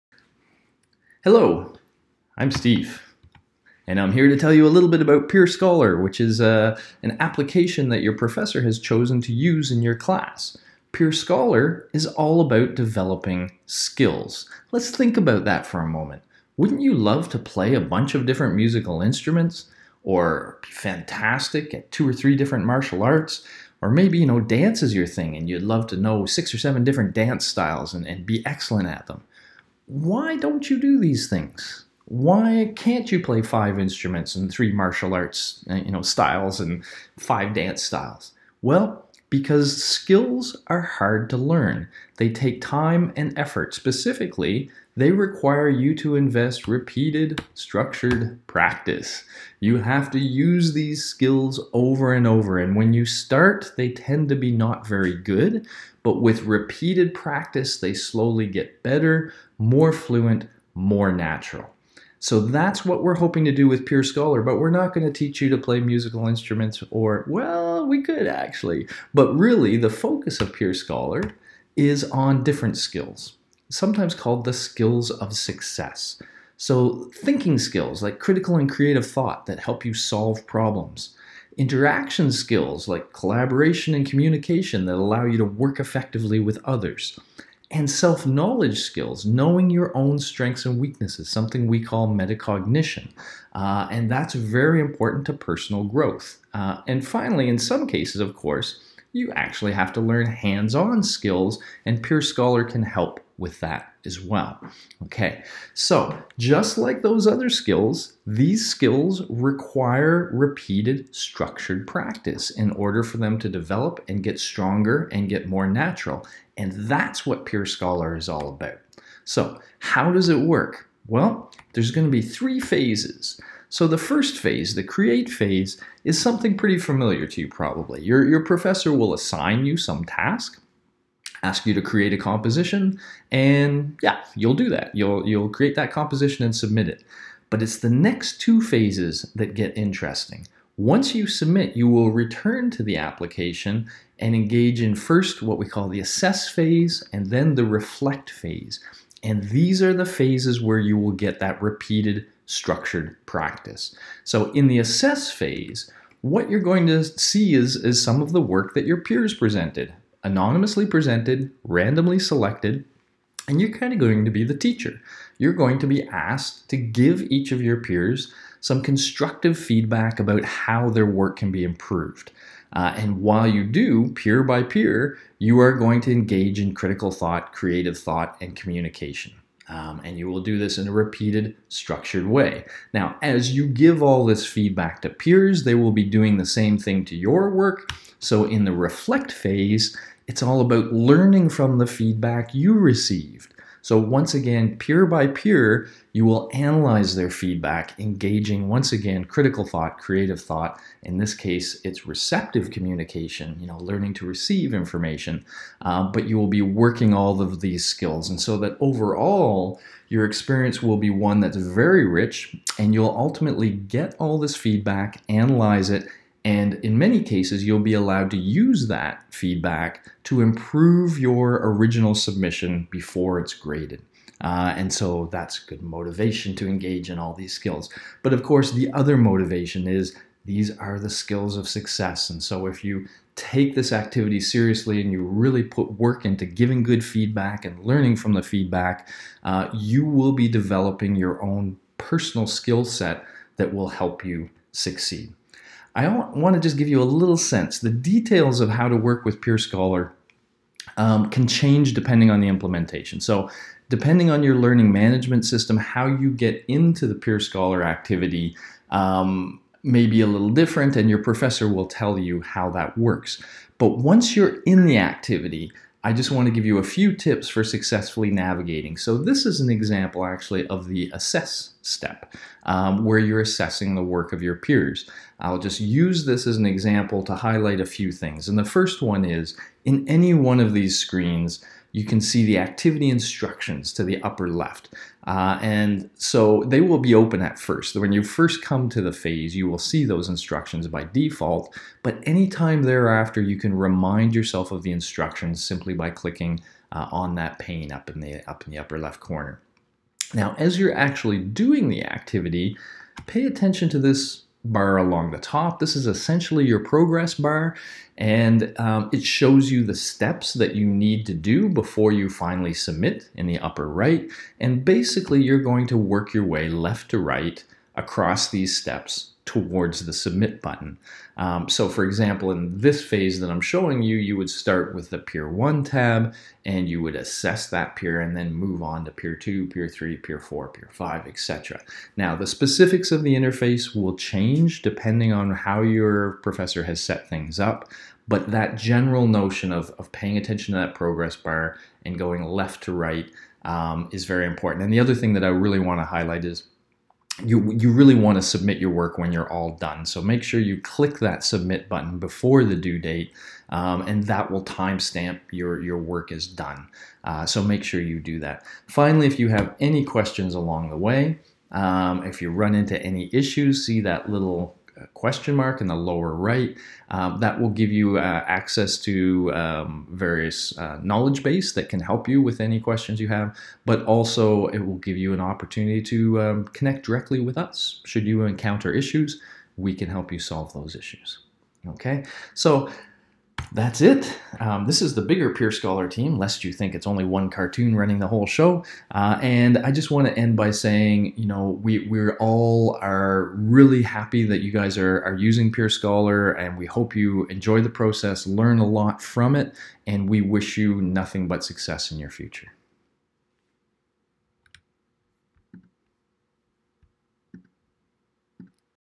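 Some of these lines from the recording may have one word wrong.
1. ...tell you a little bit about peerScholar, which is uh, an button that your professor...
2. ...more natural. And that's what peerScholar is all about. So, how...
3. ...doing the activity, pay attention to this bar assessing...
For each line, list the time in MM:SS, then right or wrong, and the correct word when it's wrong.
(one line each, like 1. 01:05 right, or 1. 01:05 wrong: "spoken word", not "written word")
1. 00:04 wrong: "application", not "button"
2. 01:55 right
3. 05:01 wrong: "along", not "assessing".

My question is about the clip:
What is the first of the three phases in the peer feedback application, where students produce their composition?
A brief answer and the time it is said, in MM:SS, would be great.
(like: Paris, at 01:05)
create phase, at 02:04.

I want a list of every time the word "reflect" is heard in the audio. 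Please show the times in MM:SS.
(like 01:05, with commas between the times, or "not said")
02:27, 03:08.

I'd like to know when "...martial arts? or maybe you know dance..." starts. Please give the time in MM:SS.
00:22.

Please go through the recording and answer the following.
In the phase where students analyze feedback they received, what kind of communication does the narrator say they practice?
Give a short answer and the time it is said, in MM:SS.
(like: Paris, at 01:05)
receptive communication, at 03:22.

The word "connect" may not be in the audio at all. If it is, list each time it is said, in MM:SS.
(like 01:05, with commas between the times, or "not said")
06:16.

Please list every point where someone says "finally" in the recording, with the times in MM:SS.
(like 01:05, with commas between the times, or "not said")
01:37, 05:12, 05:58.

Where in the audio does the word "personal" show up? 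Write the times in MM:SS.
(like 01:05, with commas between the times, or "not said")
01:35, 04:01.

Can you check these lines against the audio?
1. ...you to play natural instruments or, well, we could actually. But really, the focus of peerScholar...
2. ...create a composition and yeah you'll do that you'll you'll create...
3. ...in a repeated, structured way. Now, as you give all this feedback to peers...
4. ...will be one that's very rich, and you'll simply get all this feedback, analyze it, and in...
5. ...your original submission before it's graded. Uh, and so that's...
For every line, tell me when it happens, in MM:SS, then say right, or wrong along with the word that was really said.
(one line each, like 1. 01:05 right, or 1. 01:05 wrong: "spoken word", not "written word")
1. 01:05 wrong: "musical", not "natural"
2. 02:11 right
3. 03:00 right
4. 03:30 wrong: "ultimately", not "simply"
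5. 03:41 right.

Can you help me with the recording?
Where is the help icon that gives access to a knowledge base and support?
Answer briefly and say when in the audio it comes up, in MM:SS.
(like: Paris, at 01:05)
lower right, at 06:05.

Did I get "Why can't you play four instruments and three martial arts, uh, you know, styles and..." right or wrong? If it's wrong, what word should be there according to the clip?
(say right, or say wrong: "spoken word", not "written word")
wrong: "five", not "four".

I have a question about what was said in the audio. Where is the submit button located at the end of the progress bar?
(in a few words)
upper right.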